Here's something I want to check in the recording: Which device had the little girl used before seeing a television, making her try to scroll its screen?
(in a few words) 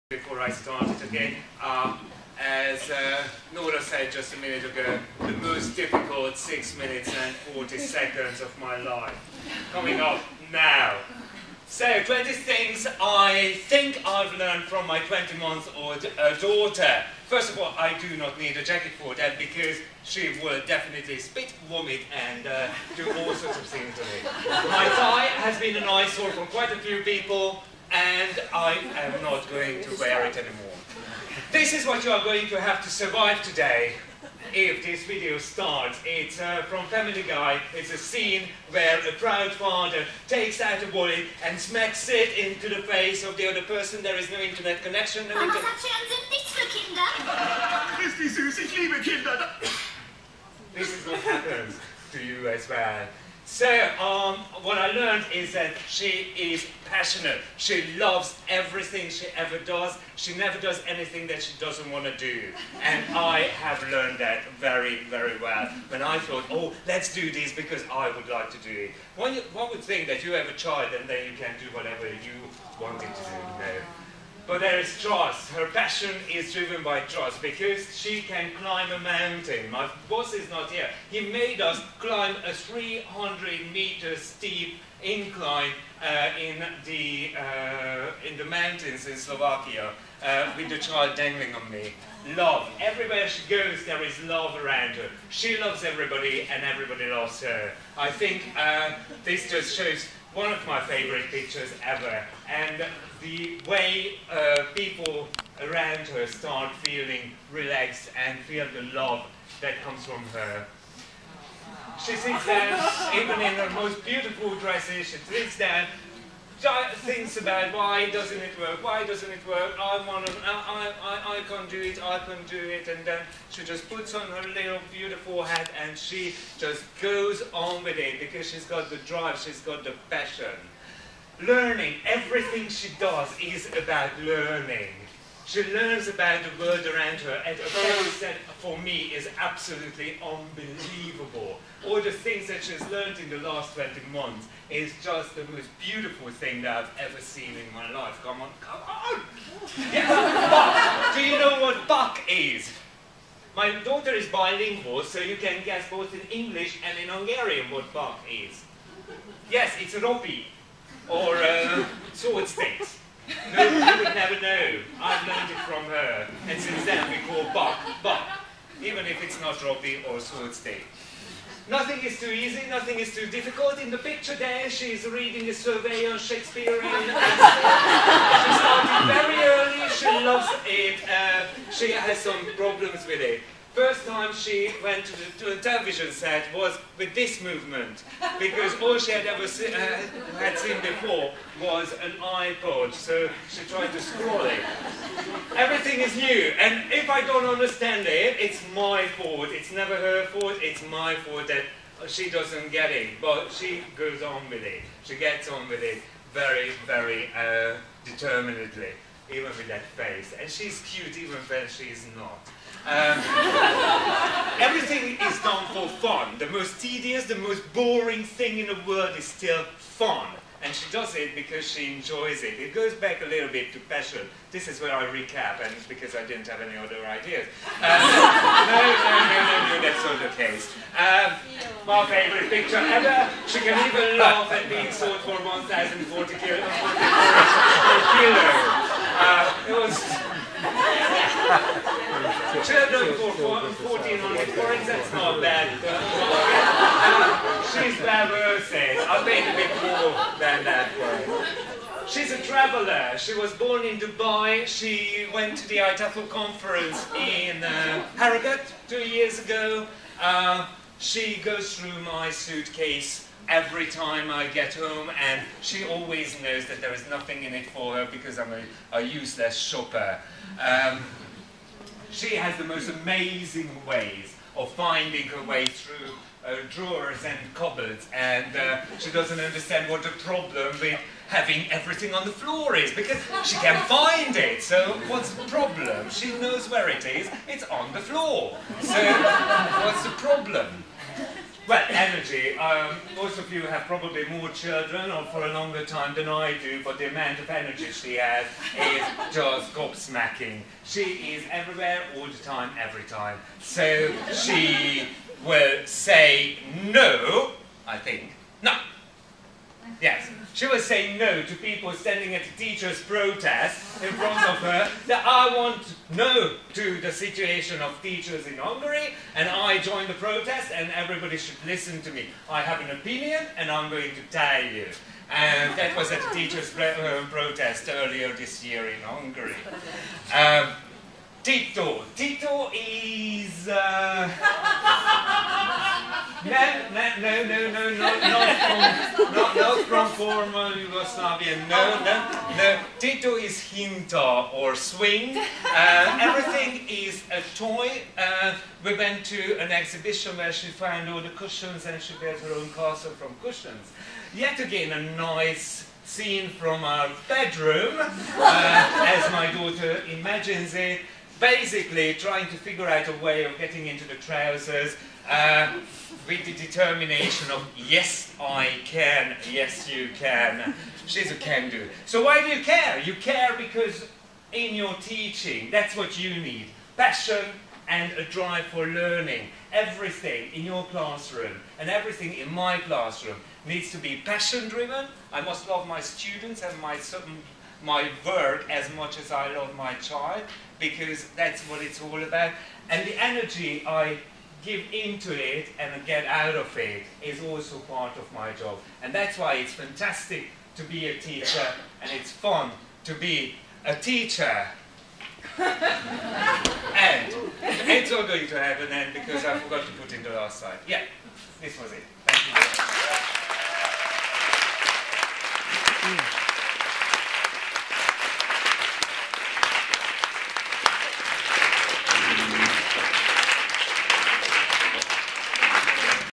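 iPod.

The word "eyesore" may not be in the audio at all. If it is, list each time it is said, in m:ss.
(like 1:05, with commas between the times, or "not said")
0:25.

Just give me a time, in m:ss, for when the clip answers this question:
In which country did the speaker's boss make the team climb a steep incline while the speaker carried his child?
1:29.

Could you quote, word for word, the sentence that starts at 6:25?
I must love my students and my my work as much as I love my child, because that's what it's all about.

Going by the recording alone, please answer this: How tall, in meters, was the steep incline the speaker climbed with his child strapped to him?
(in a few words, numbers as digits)
300.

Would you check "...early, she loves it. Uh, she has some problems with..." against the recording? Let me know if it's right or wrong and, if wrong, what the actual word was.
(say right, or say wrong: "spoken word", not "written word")
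right.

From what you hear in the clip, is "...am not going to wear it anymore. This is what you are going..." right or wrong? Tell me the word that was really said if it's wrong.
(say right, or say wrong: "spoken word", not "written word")
right.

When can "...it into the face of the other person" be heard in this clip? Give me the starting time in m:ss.
0:42.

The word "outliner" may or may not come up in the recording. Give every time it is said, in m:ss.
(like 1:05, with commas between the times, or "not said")
not said.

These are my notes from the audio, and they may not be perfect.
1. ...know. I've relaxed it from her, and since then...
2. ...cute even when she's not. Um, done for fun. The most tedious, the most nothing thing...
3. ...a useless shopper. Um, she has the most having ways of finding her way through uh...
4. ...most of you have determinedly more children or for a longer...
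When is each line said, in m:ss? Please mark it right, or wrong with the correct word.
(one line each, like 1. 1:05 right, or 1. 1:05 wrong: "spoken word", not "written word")
1. 2:44 wrong: "learned", not "relaxed"
2. 3:30 wrong: "boring", not "nothing"
3. 4:28 wrong: "amazing", not "having"
4. 4:53 wrong: "probably", not "determinedly".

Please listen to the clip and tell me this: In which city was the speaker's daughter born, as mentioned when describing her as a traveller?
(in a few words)
Dubai.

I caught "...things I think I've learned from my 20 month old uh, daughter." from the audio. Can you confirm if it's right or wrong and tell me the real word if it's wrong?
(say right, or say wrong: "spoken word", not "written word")
right.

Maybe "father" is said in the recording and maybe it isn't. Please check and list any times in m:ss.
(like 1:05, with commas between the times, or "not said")
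0:39.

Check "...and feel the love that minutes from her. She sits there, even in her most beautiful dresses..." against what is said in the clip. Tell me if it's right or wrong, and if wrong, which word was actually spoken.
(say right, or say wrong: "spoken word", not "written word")
wrong: "comes", not "minutes".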